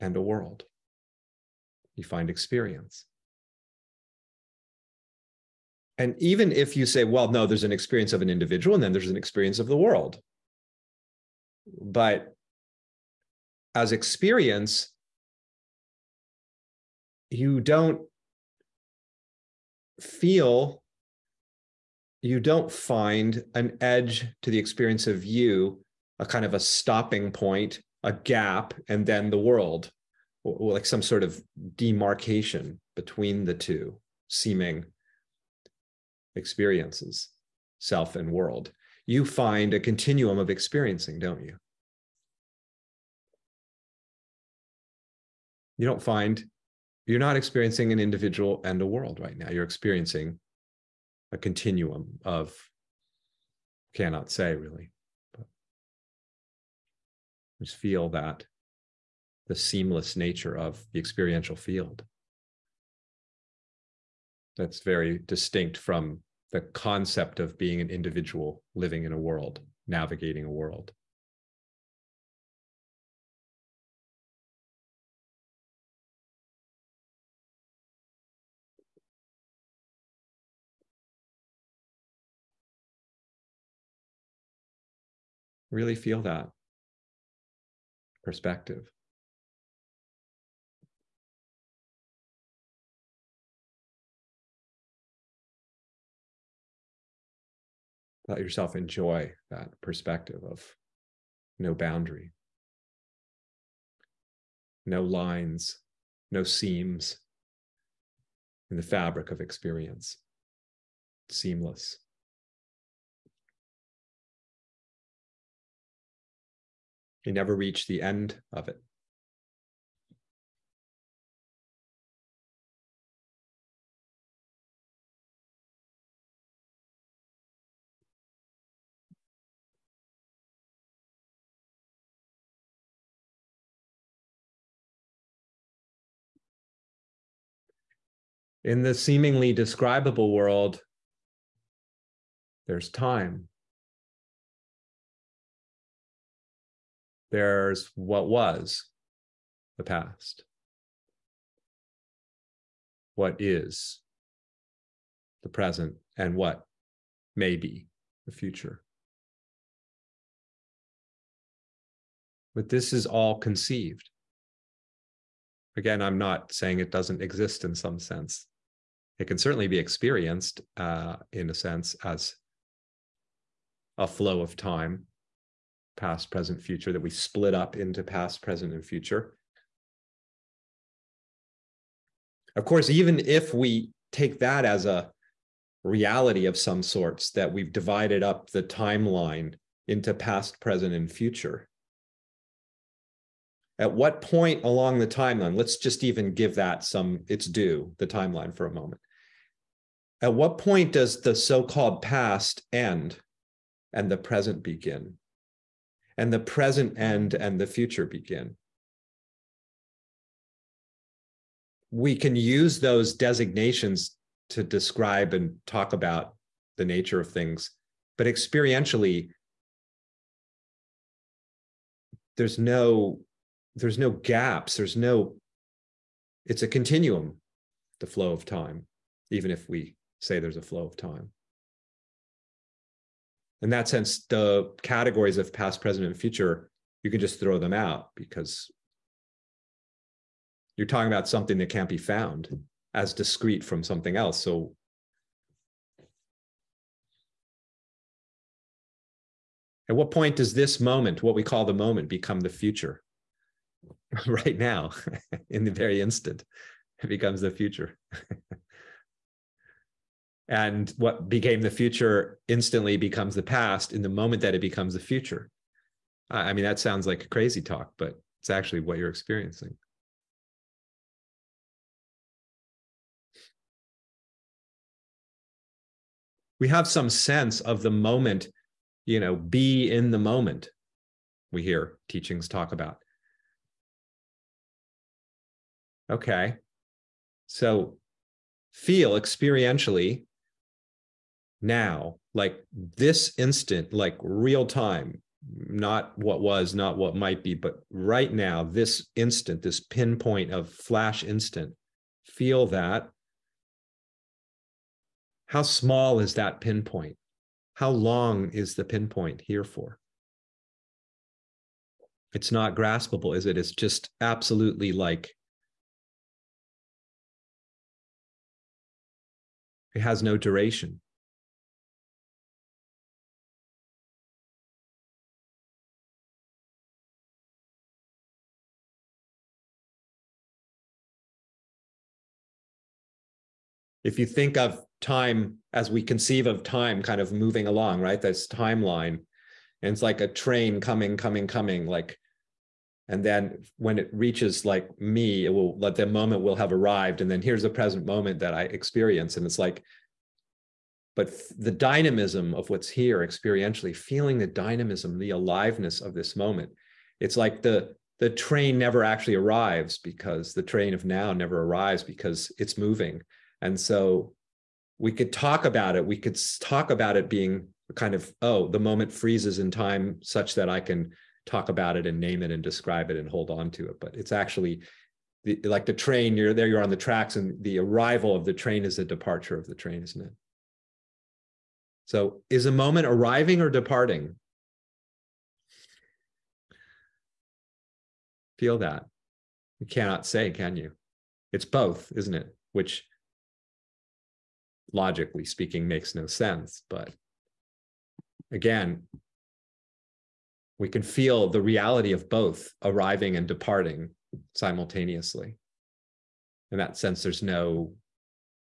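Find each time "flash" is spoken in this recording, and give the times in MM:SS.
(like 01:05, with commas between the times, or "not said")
05:00.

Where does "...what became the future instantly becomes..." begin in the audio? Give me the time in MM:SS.
04:20.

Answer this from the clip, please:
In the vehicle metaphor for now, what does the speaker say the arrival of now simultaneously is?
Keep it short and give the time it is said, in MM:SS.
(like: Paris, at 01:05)
The departure, at 06:18.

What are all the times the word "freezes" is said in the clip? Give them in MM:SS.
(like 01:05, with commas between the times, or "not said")
06:09.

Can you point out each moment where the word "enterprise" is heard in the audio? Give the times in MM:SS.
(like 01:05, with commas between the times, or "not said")
not said.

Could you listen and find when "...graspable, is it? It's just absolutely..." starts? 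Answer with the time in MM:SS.
05:12.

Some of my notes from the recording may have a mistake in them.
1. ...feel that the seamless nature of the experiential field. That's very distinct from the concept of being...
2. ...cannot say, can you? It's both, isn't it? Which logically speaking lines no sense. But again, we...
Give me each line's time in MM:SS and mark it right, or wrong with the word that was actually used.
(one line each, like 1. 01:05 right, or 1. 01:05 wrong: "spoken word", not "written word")
1. 00:57 right
2. 06:29 wrong: "makes", not "lines".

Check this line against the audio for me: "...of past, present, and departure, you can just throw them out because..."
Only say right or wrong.
wrong.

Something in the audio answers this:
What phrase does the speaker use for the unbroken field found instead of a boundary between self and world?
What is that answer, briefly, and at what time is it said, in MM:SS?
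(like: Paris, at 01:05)
continuum of experiencing, at 00:39.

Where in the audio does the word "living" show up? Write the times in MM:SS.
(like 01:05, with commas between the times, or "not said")
01:08.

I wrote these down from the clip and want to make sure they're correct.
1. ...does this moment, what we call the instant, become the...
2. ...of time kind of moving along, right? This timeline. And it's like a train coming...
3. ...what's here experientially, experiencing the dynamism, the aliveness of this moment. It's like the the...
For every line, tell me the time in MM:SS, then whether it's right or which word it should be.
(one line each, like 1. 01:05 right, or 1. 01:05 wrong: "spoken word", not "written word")
1. 04:10 wrong: "moment", not "instant"
2. 05:36 right
3. 05:52 wrong: "feeling", not "experiencing".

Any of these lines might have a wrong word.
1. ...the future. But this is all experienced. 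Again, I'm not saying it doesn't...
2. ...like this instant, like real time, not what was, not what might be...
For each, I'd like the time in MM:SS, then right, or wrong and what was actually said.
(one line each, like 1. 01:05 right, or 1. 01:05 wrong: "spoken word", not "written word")
1. 02:38 wrong: "conceived", not "experienced"
2. 04:52 right.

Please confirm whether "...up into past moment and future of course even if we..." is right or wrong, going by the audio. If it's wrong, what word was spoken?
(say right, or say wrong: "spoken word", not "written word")
wrong: "present", not "moment".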